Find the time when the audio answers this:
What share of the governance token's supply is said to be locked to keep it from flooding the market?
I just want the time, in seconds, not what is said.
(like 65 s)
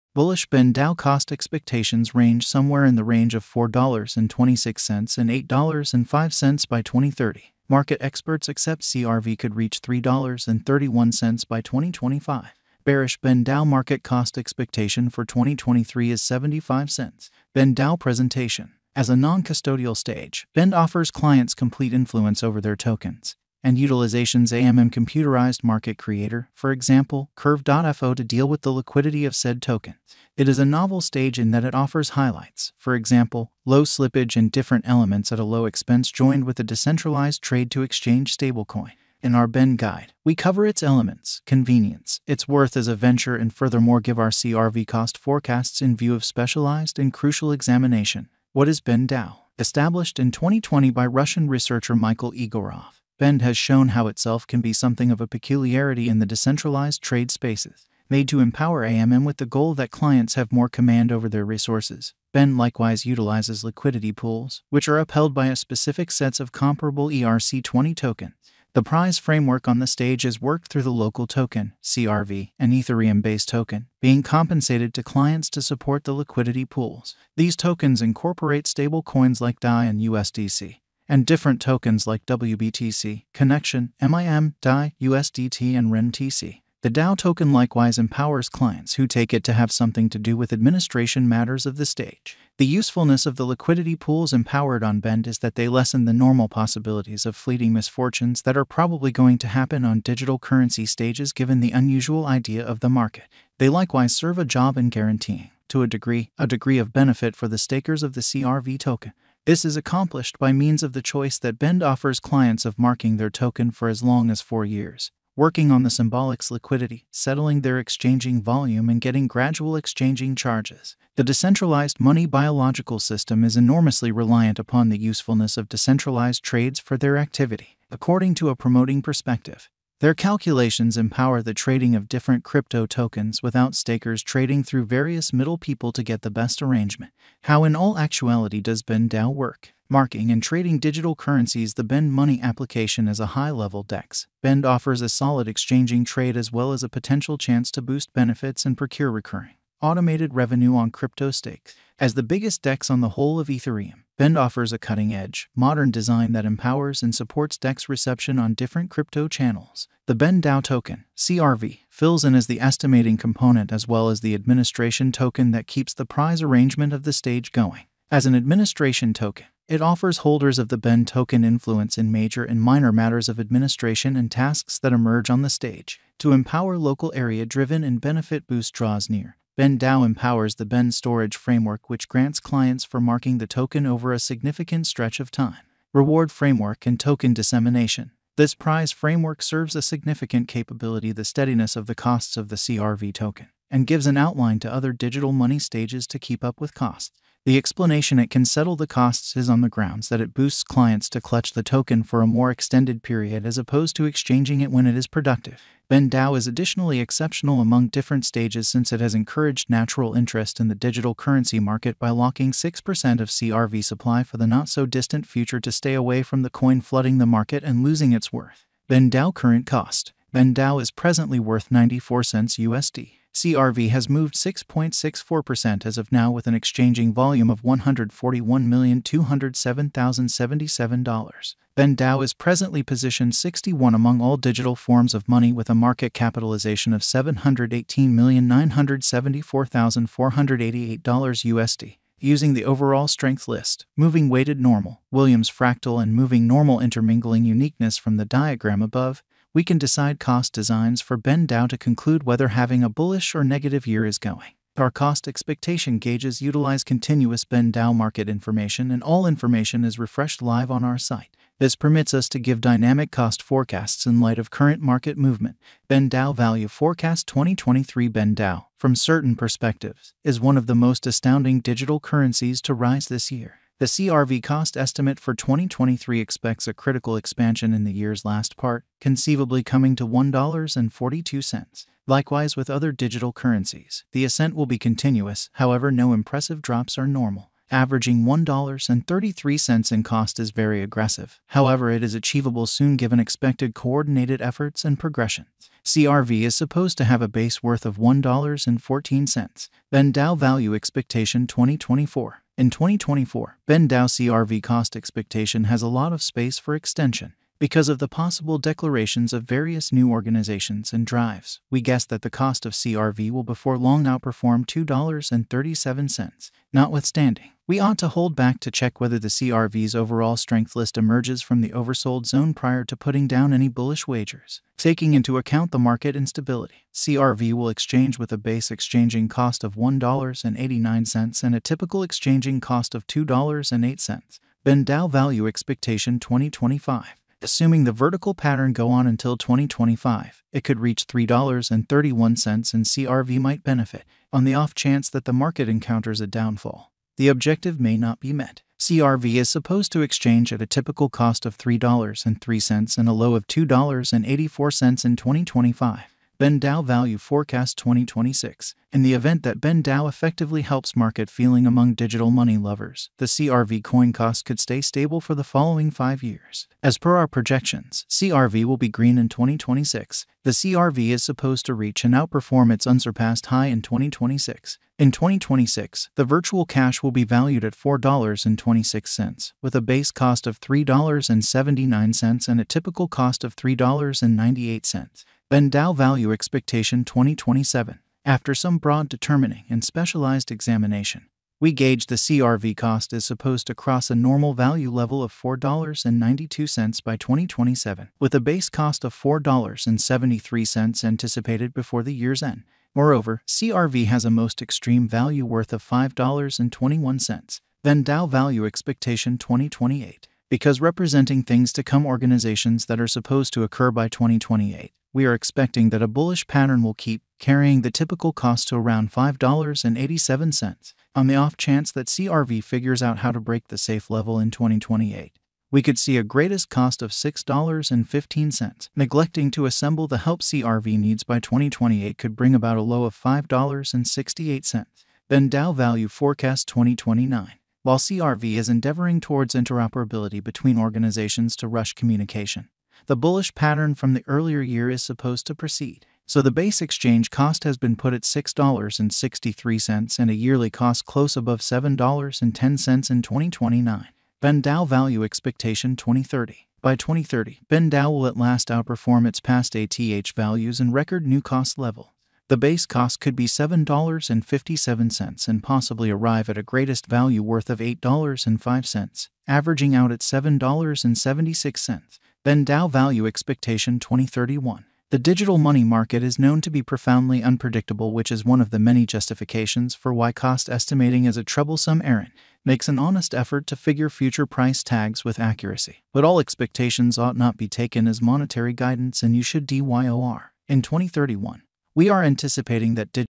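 212 s.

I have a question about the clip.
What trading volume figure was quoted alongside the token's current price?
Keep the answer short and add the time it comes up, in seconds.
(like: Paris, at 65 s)
$141,207,077, at 227 s.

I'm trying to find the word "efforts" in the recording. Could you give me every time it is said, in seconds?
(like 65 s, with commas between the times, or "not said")
294 s, 483 s.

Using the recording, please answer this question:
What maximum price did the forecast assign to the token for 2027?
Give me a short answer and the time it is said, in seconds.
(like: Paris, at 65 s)
$5.21, at 405 s.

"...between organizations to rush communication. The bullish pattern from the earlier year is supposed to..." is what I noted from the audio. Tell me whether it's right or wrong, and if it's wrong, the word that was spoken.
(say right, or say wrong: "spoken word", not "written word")
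right.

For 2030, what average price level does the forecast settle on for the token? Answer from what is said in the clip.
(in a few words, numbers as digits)
$7.76.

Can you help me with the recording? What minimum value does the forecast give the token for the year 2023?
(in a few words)
$1.14.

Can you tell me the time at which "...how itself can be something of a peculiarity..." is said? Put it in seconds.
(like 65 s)
53 s.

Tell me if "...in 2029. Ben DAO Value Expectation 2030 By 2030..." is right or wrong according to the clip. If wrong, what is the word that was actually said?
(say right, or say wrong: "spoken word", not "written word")
right.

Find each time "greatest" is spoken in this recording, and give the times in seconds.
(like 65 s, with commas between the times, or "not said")
426 s, 466 s.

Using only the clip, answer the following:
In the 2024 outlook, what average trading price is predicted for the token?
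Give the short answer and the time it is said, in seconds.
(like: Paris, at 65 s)
$2.08, at 333 s.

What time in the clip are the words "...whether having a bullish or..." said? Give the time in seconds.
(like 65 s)
252 s.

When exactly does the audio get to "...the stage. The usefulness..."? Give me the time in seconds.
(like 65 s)
91 s.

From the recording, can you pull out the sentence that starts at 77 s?
These tokens incorporate stable coins like DAI and USDC and different tokens like WBTC, Connection, MIM, DAI, USDT, and renBTC.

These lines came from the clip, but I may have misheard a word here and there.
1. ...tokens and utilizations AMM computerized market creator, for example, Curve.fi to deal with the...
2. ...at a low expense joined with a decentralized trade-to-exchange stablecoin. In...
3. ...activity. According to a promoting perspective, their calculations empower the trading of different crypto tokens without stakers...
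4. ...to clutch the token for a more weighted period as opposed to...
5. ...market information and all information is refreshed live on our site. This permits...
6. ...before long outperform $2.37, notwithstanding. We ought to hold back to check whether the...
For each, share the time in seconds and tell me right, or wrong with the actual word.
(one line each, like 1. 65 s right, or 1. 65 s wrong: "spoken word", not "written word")
1. 22 s right
2. 35 s right
3. 127 s right
4. 201 s wrong: "extended", not "weighted"
5. 257 s right
6. 313 s right.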